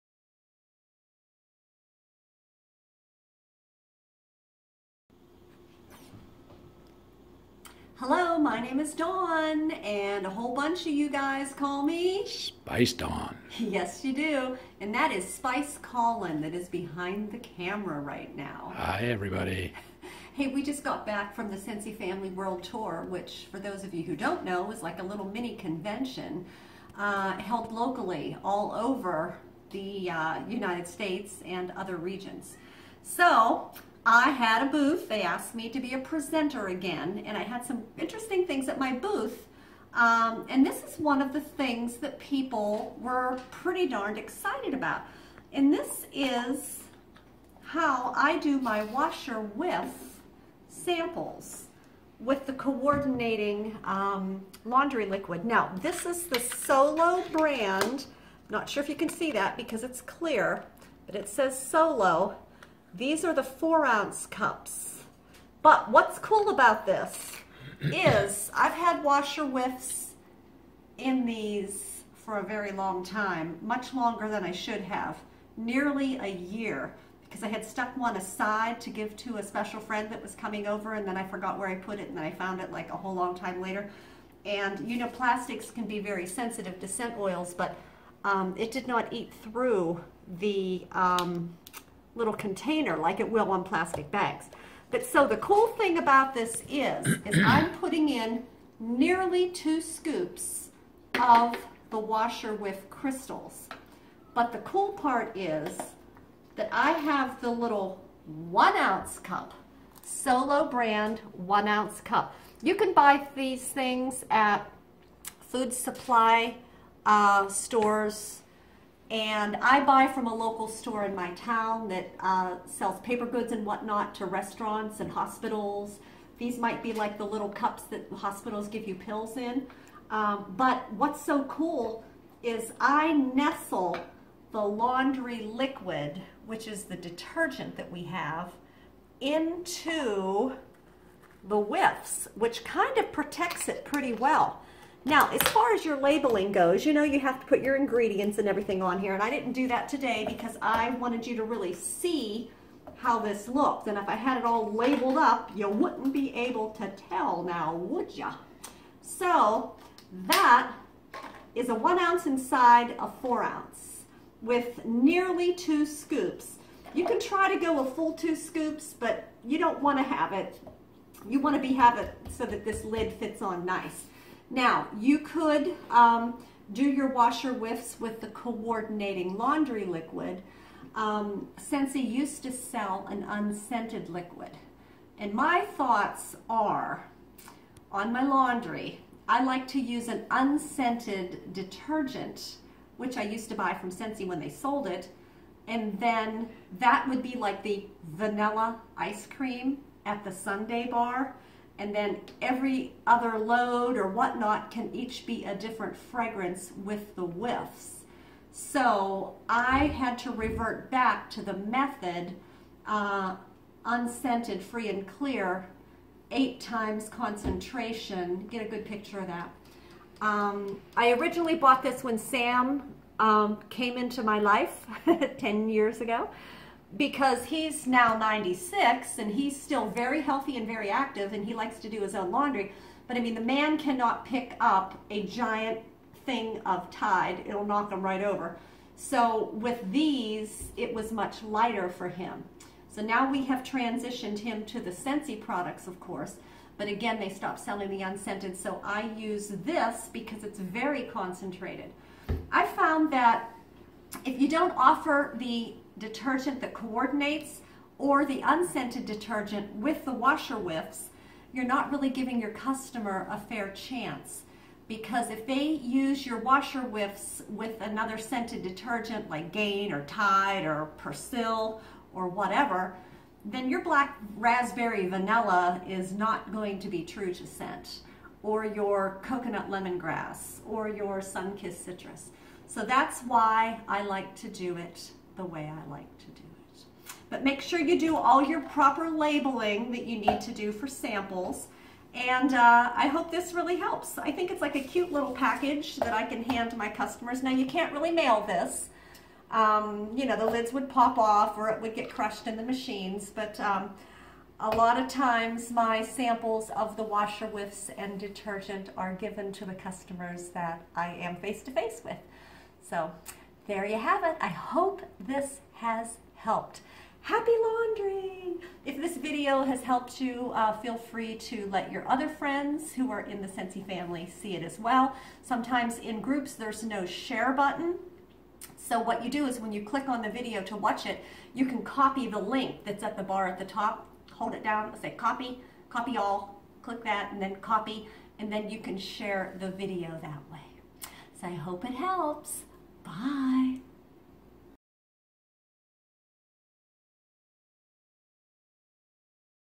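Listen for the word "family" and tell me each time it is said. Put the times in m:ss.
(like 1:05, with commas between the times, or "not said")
0:21, 5:23.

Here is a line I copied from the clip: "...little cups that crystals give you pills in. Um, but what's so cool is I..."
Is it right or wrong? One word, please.
wrong.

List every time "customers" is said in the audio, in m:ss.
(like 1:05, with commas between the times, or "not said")
4:22, 4:56, 5:09.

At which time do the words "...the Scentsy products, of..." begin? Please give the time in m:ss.
4:04.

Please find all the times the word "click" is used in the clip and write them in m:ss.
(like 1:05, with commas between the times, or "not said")
5:29, 5:36.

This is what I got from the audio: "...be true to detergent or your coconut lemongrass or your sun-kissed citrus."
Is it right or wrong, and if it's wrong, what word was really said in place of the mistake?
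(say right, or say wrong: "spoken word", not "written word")
wrong: "scent", not "detergent".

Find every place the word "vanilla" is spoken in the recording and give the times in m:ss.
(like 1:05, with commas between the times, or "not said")
3:18, 4:35.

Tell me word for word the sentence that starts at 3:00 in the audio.
Um, Scentsy used to sell an unscented liquid.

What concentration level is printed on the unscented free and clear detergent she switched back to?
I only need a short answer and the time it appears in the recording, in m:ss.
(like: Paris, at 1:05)
8 times, at 3:36.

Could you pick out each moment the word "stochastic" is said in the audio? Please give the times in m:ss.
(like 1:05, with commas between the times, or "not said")
not said.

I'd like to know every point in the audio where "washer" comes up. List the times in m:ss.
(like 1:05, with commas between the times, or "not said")
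0:48, 1:09, 1:41, 2:57, 4:20, 4:26, 5:07.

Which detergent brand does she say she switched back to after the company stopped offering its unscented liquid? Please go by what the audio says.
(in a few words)
Method.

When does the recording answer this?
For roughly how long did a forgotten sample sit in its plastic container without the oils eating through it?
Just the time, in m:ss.
1:15.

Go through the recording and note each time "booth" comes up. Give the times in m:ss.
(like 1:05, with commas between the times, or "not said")
0:34, 0:38.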